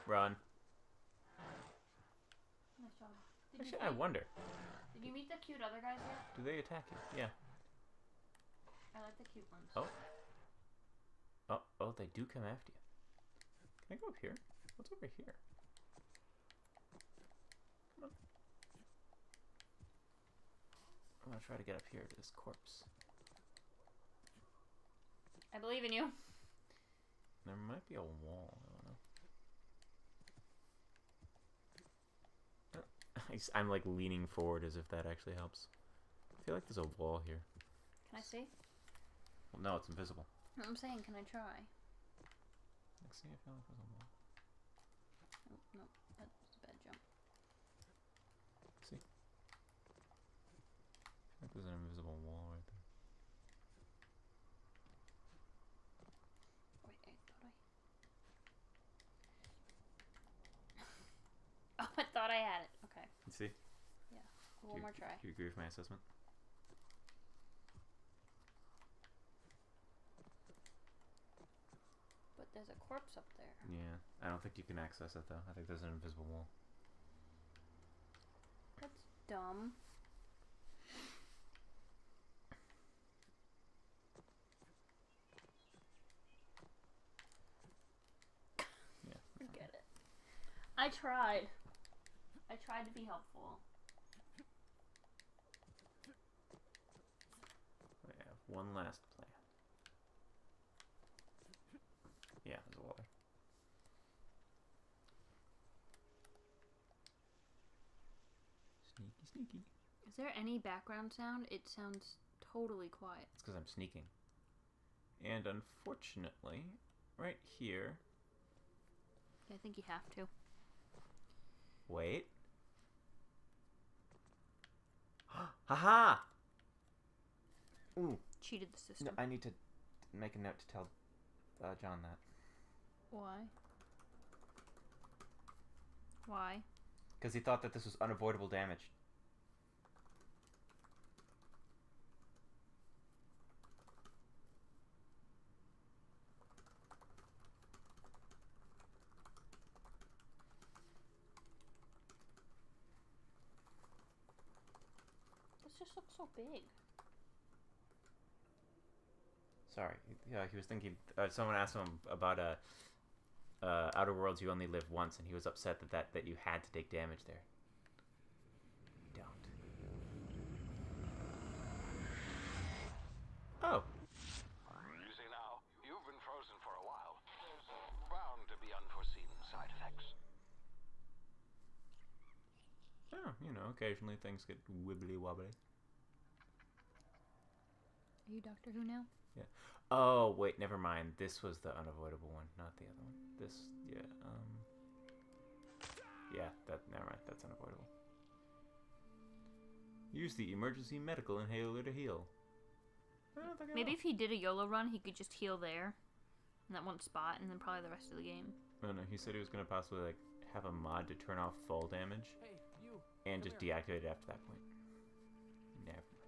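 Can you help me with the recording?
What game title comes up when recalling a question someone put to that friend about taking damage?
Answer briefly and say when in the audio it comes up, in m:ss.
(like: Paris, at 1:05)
Outer Worlds, at 2:43.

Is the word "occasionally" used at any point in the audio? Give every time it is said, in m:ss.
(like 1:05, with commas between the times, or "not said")
3:03.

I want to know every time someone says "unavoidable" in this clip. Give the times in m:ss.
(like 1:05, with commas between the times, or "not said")
2:18, 3:11, 3:17.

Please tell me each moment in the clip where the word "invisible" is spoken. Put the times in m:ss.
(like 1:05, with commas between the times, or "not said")
0:39, 0:51, 1:15.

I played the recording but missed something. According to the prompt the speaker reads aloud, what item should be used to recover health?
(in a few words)
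emergency medical inhaler.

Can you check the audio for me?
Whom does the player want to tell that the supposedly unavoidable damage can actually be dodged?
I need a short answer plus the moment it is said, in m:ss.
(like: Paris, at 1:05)
John, at 2:11.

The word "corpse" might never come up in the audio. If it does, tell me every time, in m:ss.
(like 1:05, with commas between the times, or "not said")
0:22, 1:12.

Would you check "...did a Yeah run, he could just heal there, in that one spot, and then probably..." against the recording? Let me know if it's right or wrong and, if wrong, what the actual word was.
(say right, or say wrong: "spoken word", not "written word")
wrong: "YOLO", not "Yeah".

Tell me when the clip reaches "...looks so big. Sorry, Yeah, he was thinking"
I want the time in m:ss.
2:35.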